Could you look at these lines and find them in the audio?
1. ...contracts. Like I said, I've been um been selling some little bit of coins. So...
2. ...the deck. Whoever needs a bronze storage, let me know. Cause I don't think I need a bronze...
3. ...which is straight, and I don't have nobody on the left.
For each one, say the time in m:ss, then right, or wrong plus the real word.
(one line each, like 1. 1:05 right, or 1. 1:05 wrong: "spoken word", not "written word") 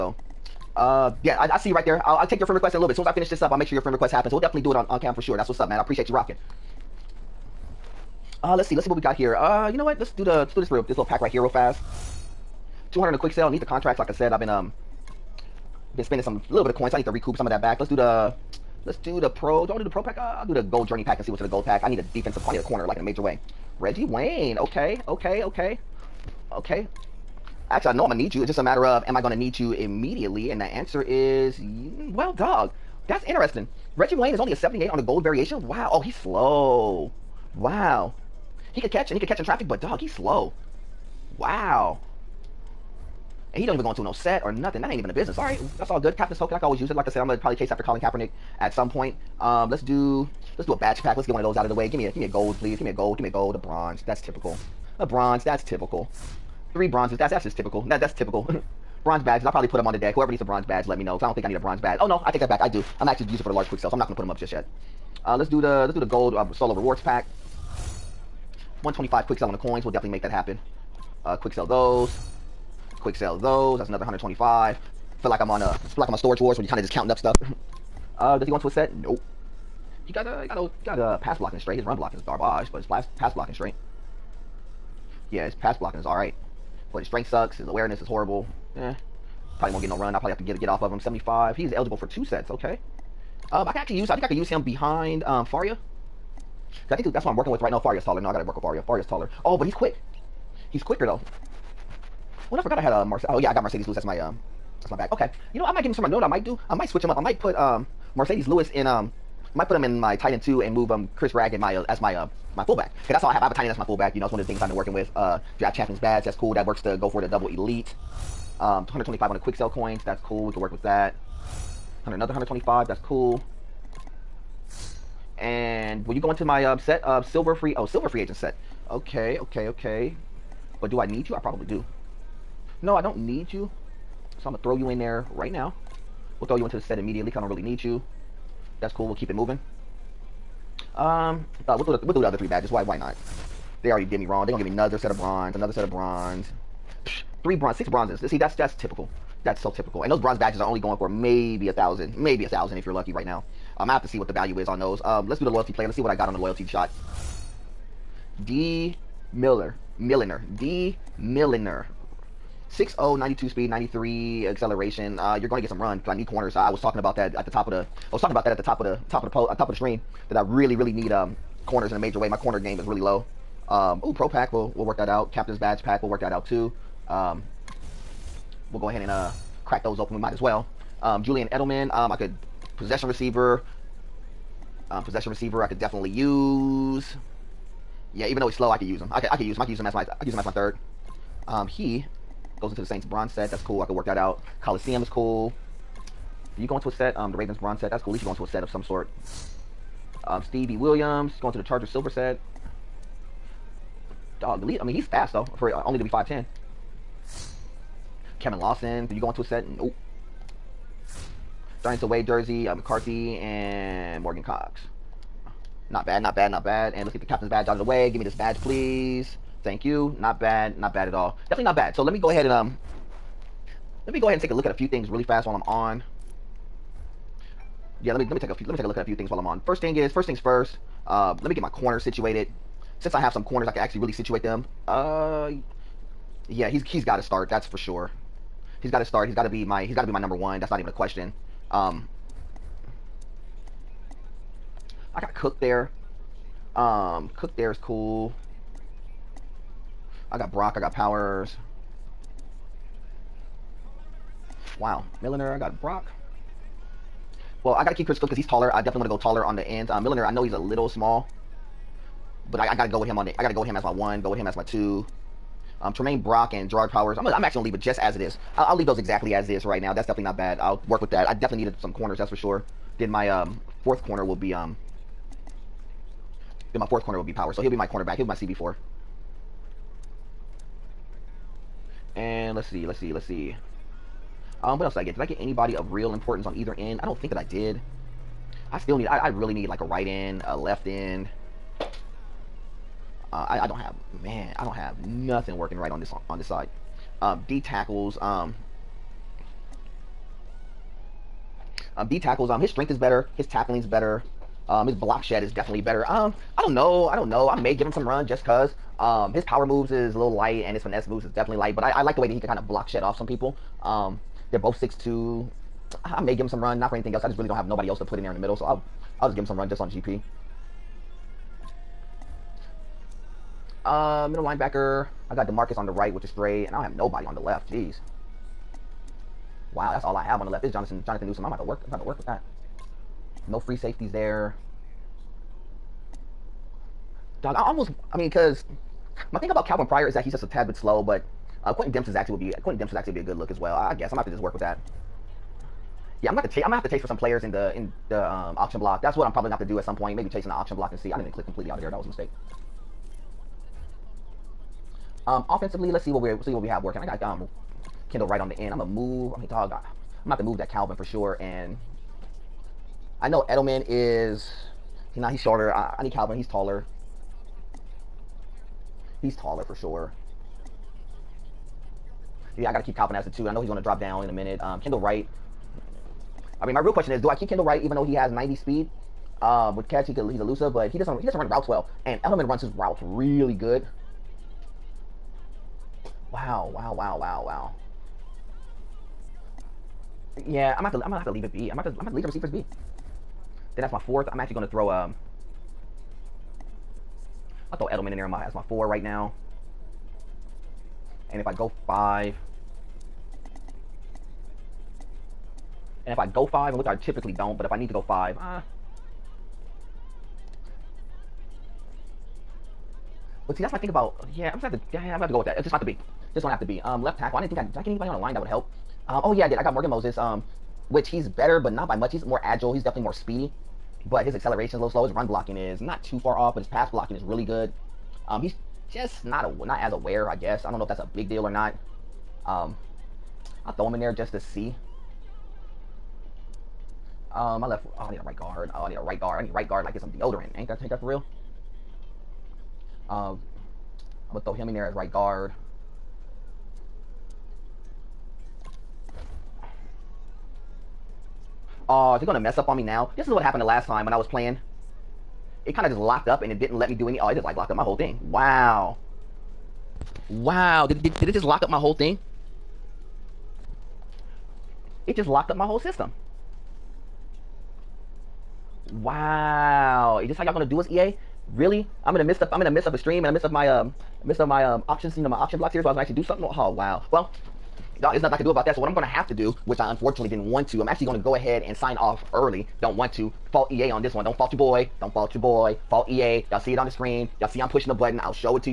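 1. 0:13 wrong: "spending", not "selling"
2. 0:59 wrong: "badge", not "storage"
3. 5:26 right.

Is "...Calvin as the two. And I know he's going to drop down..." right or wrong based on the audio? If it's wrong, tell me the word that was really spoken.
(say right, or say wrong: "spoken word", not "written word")
right.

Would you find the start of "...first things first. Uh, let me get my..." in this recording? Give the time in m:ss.
3:50.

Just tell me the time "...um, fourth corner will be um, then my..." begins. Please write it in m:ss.
4:33.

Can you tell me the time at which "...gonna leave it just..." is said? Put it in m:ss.
4:27.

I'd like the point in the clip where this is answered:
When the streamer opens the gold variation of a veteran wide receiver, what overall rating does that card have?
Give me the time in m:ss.
0:34.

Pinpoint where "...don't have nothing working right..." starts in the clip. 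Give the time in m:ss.
4:54.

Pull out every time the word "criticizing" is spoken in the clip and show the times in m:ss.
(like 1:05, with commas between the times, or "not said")
not said.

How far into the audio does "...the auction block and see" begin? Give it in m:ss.
5:50.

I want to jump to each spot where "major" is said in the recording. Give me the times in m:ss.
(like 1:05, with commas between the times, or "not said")
0:23, 2:51.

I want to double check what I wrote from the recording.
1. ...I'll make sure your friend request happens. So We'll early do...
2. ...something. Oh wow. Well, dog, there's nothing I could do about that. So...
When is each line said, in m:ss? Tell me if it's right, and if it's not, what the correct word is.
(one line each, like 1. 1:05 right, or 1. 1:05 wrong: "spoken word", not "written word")
1. 0:03 wrong: "definitely", not "early"
2. 7:56 right.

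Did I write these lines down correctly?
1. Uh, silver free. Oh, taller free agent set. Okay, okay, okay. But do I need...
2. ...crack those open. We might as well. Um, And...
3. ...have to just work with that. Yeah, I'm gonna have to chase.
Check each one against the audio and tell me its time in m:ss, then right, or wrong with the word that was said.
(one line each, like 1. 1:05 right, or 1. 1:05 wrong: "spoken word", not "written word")
1. 2:07 wrong: "silver", not "taller"
2. 2:59 wrong: "Julian", not "And"
3. 5:44 right.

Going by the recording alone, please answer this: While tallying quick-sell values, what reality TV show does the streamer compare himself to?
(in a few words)
Storage Wars.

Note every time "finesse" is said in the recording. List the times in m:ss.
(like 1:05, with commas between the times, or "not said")
5:10.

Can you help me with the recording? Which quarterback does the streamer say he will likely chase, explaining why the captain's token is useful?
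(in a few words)
Colin Kaepernick.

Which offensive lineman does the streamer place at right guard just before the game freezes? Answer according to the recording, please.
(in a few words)
Morgan Moses.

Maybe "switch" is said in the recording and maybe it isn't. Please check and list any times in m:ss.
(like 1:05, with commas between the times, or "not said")
1:46.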